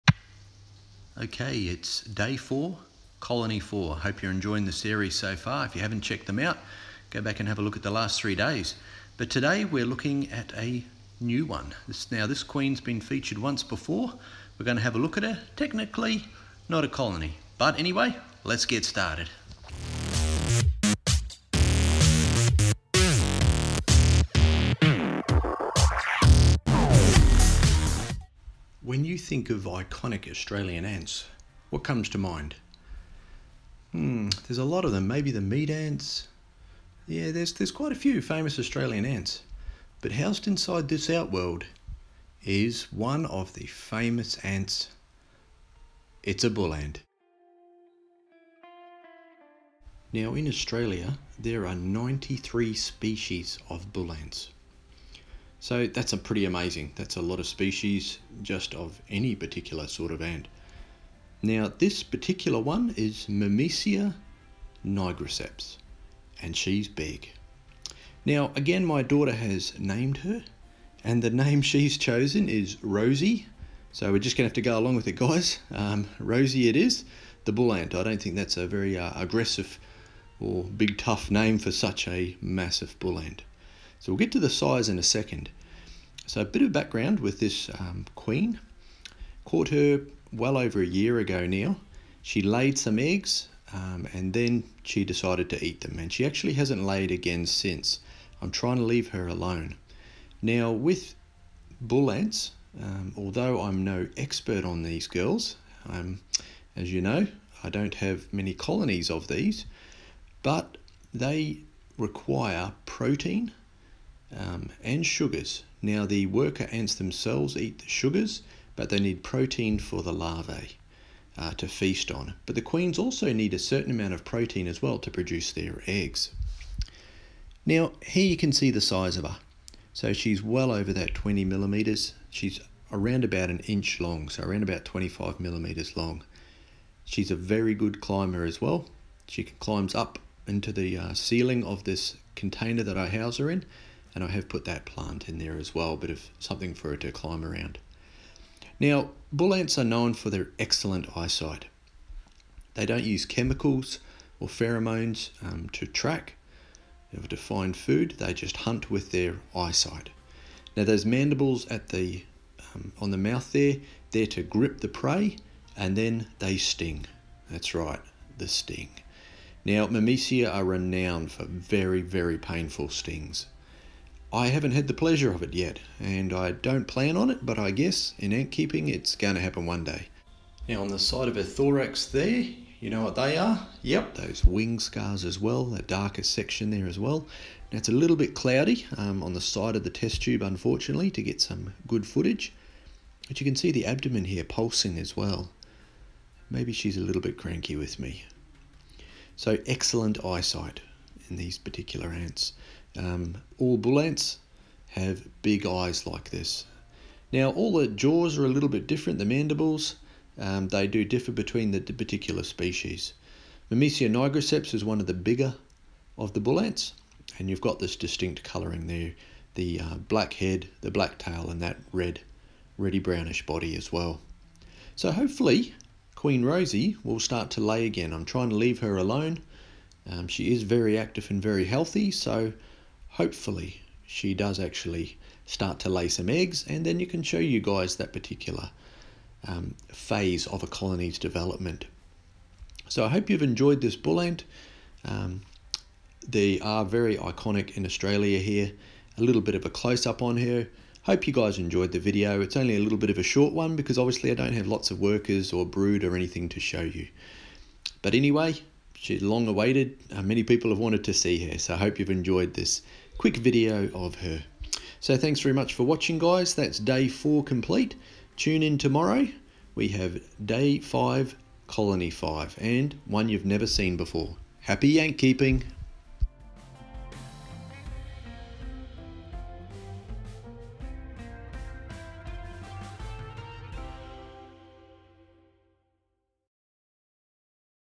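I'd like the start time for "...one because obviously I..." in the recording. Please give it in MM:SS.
04:13.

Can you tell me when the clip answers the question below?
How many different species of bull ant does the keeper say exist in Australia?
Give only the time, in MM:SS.
00:51.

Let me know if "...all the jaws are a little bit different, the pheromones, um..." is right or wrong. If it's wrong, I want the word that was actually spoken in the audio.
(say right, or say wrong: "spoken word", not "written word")
wrong: "mandibles", not "pheromones".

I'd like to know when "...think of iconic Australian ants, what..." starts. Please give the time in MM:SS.
00:29.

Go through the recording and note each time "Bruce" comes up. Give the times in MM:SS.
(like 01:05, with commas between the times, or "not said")
not said.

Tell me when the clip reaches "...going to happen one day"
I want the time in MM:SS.
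02:59.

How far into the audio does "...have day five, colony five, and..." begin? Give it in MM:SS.
04:29.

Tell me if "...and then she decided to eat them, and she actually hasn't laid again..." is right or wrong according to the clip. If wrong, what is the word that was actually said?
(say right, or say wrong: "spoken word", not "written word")
right.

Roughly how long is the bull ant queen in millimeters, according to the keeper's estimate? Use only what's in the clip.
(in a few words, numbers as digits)
25 millimeters.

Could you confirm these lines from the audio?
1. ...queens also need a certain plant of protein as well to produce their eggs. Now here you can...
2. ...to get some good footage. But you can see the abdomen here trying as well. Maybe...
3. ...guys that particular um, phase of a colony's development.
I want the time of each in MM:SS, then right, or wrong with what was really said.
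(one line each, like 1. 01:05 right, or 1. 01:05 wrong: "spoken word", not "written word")
1. 02:02 wrong: "amount", not "plant"
2. 03:11 wrong: "pulsing", not "trying"
3. 03:57 right.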